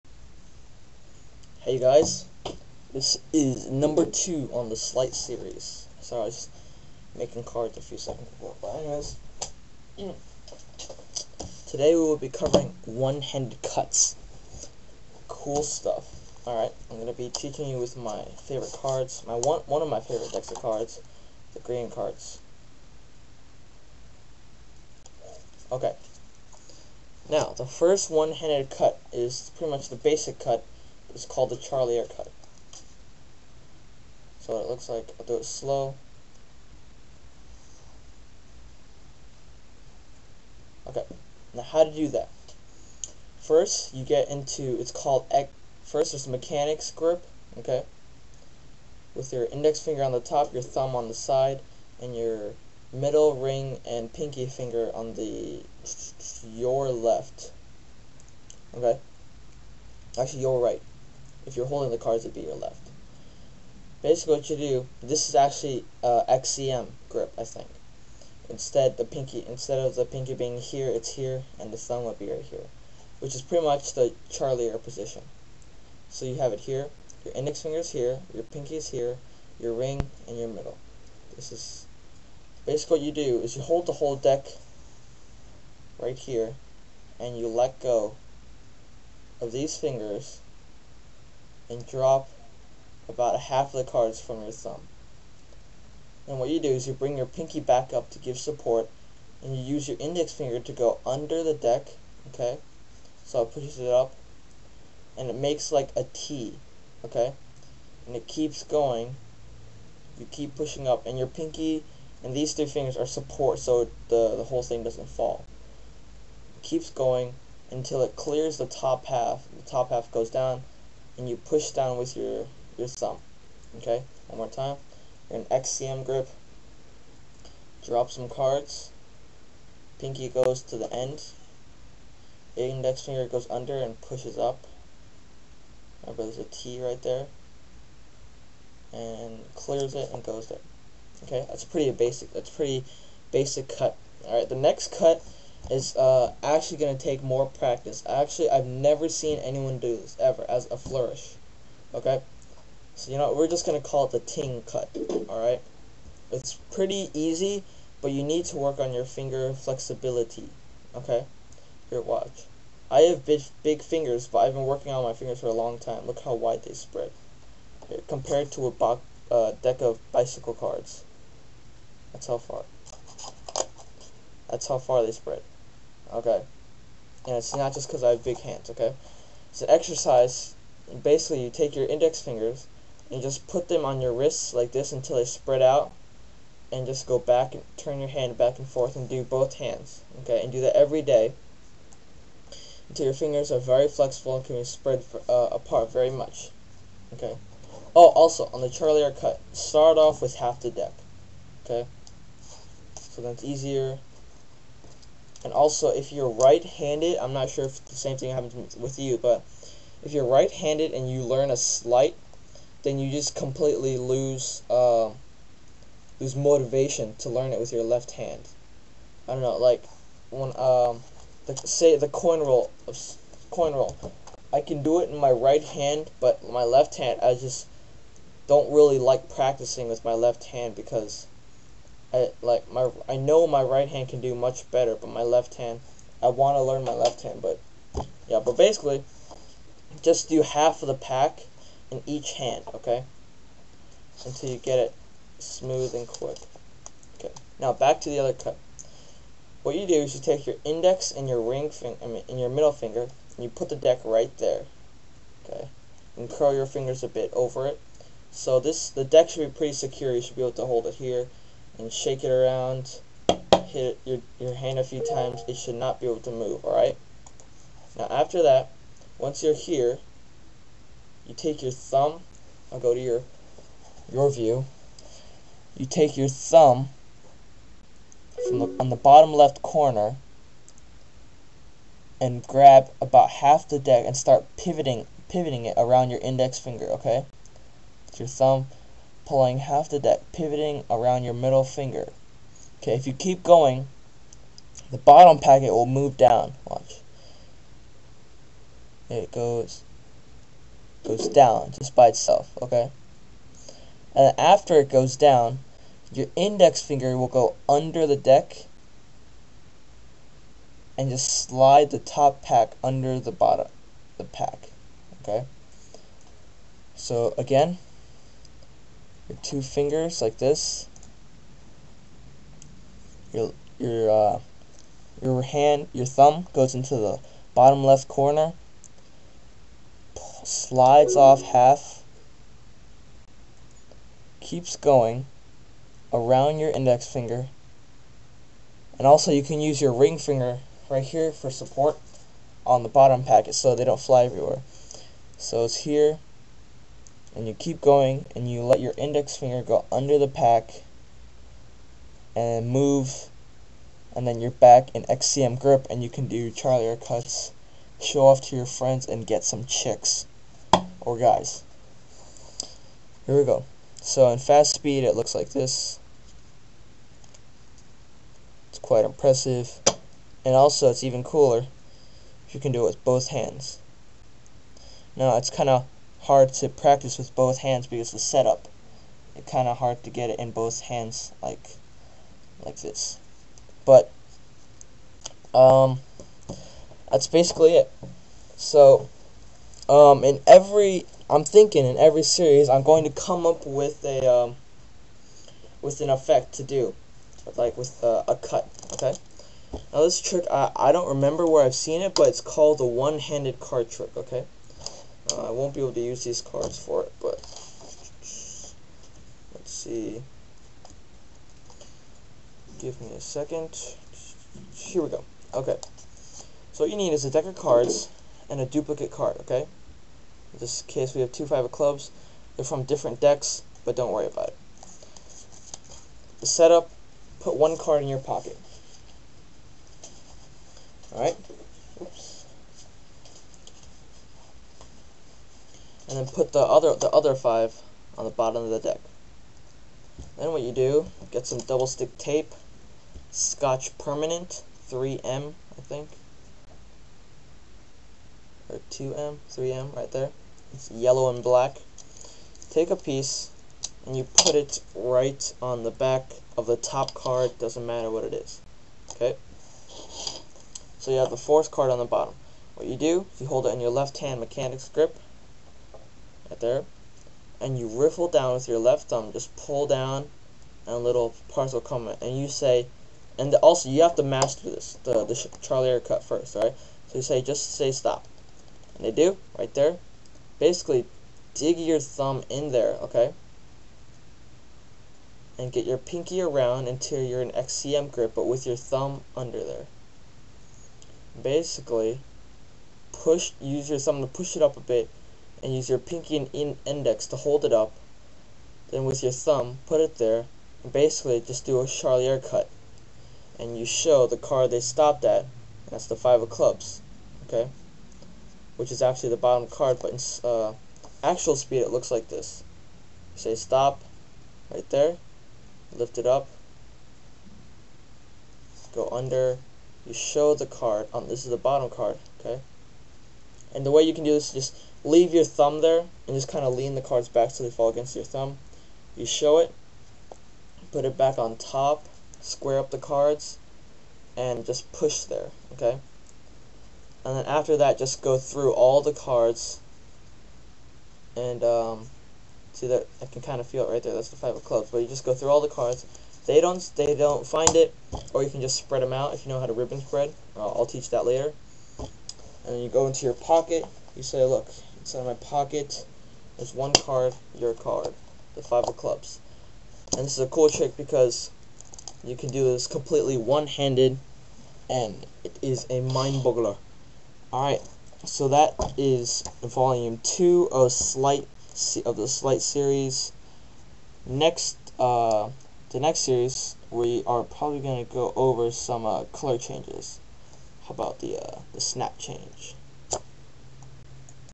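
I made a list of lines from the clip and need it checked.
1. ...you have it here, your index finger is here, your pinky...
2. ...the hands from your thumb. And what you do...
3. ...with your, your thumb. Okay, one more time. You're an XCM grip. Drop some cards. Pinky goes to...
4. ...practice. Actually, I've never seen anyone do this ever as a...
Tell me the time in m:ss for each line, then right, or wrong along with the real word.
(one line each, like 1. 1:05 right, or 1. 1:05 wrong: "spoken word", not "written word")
1. 1:16 right
2. 1:33 wrong: "cards", not "hands"
3. 2:01 right
4. 2:27 right.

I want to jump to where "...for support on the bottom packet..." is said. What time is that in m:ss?
5:41.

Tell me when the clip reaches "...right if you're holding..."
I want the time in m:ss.
1:00.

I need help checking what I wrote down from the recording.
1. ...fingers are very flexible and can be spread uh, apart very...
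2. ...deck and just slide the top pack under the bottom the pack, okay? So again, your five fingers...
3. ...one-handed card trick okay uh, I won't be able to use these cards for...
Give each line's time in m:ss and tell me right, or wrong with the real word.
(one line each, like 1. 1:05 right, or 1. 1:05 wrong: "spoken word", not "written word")
1. 3:13 right
2. 5:08 wrong: "two", not "five"
3. 6:42 right.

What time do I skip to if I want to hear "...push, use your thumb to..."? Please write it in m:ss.
8:13.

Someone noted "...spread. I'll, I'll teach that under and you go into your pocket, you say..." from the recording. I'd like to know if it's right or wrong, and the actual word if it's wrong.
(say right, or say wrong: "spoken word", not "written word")
wrong: "later", not "under".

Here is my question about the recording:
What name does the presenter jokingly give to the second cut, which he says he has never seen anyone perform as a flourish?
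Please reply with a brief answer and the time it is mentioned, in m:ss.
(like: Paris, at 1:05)
ting cut, at 2:34.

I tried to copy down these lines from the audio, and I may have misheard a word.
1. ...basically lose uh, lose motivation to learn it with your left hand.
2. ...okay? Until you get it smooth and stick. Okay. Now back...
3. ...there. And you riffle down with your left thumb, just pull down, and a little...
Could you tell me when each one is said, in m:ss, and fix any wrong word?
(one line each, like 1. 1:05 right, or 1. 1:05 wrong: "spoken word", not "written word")
1. 3:33 wrong: "completely", not "basically"
2. 4:02 wrong: "quick", not "stick"
3. 7:46 right.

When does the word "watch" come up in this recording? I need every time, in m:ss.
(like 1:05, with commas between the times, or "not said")
2:42, 4:56.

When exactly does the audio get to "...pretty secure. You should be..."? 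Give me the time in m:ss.
4:19.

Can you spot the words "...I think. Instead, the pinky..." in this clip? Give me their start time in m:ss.
1:07.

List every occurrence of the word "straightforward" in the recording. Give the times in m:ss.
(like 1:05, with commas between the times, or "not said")
not said.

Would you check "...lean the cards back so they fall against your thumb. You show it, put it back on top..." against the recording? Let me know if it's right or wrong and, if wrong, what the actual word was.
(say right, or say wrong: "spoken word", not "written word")
right.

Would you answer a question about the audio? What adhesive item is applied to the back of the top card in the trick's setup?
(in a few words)
double stick tape.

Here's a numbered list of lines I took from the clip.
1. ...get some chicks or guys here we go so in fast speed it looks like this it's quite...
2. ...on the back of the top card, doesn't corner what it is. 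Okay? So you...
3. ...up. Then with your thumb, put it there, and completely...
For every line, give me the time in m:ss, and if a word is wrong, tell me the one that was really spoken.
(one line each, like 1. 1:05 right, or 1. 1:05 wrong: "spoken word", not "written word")
1. 5:59 right
2. 7:35 wrong: "matter", not "corner"
3. 8:17 wrong: "basically", not "completely".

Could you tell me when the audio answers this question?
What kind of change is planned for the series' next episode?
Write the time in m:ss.
9:41.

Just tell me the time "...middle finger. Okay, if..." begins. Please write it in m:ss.
4:51.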